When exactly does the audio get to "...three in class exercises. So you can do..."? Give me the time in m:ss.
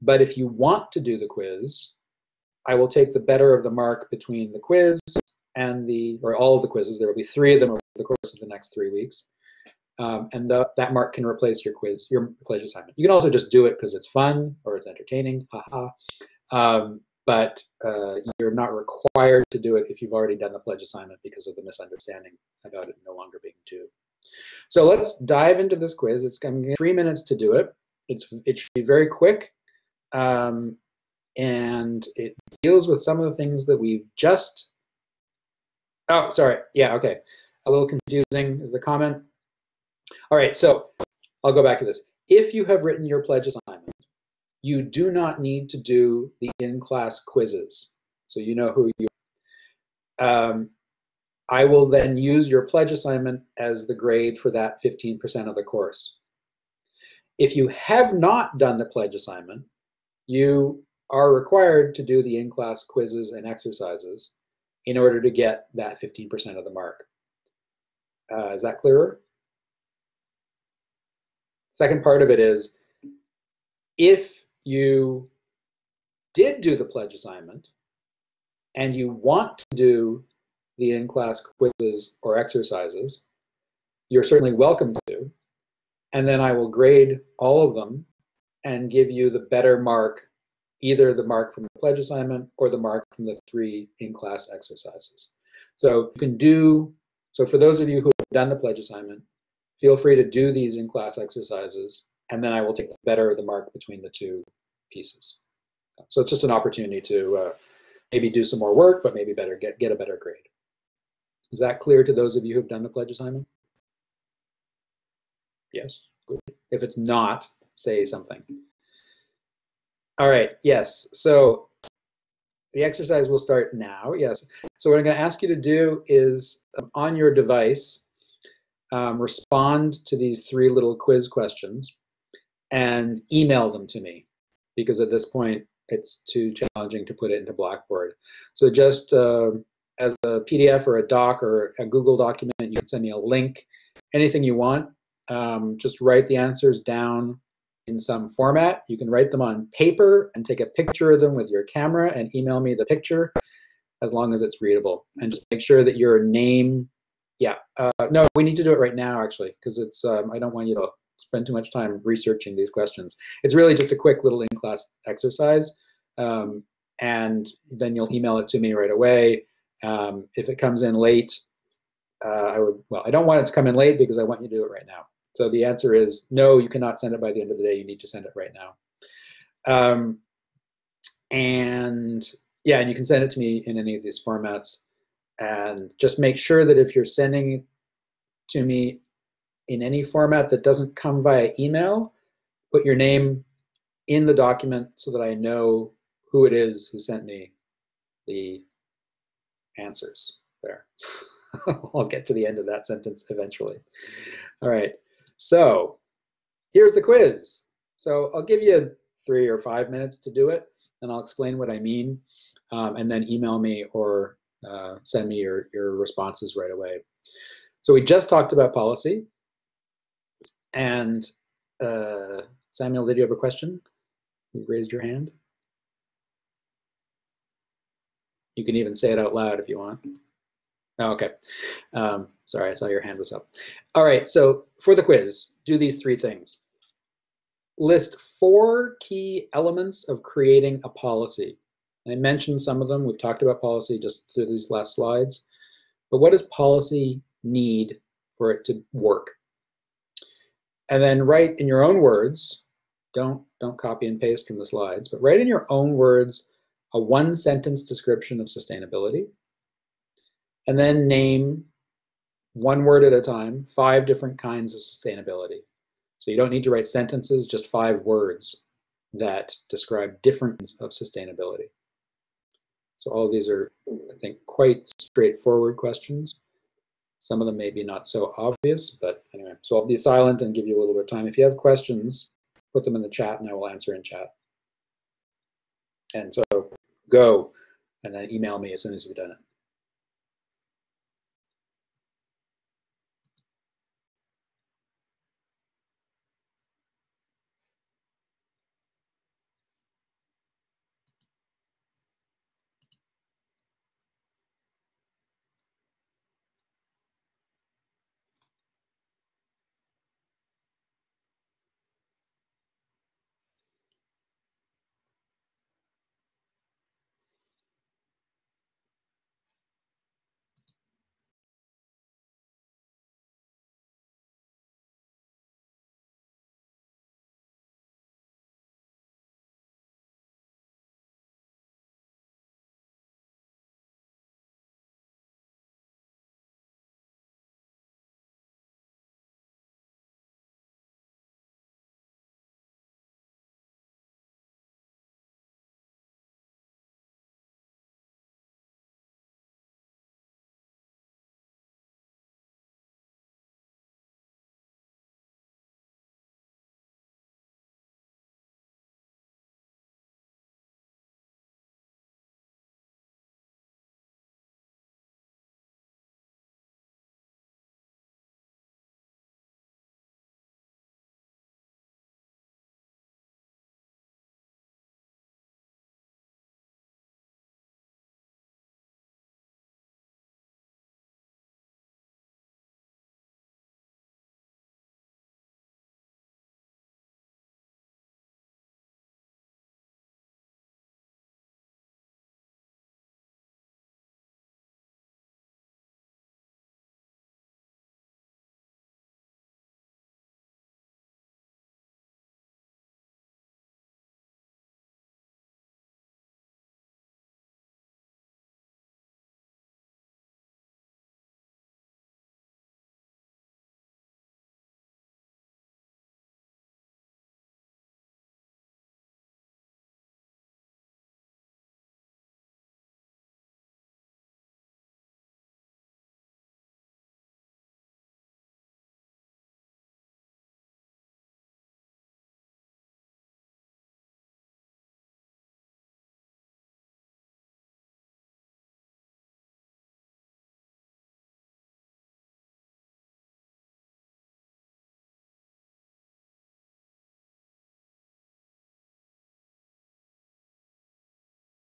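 1:33.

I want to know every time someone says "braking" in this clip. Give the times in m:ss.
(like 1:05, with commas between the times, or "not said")
not said.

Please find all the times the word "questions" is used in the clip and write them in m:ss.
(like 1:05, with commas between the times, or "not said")
2:11, 2:42, 3:43, 4:35, 4:41.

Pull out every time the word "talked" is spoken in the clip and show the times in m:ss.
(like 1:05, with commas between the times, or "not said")
3:38, 4:03.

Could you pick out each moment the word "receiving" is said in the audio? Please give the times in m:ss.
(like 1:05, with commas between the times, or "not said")
not said.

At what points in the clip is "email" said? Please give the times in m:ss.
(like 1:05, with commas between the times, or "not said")
2:13, 2:32, 2:48, 3:11, 3:33, 4:48.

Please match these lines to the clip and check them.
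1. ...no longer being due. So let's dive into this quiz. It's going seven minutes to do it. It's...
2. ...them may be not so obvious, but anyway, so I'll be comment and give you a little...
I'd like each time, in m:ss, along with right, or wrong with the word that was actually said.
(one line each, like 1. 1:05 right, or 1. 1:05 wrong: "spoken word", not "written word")
1. 0:23 wrong: "three", not "seven"
2. 4:37 wrong: "silent", not "comment".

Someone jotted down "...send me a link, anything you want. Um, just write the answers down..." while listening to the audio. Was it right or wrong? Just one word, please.
right.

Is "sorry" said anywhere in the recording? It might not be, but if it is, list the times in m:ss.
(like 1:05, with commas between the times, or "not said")
0:36, 3:52.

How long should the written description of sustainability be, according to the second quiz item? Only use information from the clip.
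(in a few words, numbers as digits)
one sentence.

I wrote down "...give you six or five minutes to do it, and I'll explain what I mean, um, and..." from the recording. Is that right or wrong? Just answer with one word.
wrong.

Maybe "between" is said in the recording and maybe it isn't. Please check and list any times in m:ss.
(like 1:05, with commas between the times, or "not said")
0:04, 1:43.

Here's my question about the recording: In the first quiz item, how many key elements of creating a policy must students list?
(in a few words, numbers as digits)
4.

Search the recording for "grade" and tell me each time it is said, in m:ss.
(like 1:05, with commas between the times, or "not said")
0:53, 1:26, 1:50.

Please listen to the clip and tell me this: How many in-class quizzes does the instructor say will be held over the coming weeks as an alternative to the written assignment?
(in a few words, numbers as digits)
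3.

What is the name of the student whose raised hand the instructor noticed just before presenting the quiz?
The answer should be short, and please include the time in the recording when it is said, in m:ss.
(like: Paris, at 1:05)
Samuel, at 3:42.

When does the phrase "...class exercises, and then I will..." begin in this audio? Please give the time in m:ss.
1:40.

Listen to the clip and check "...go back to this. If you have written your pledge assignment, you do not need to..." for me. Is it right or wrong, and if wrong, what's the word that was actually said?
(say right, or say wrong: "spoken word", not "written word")
right.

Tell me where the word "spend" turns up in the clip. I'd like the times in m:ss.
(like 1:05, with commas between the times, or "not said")
2:41.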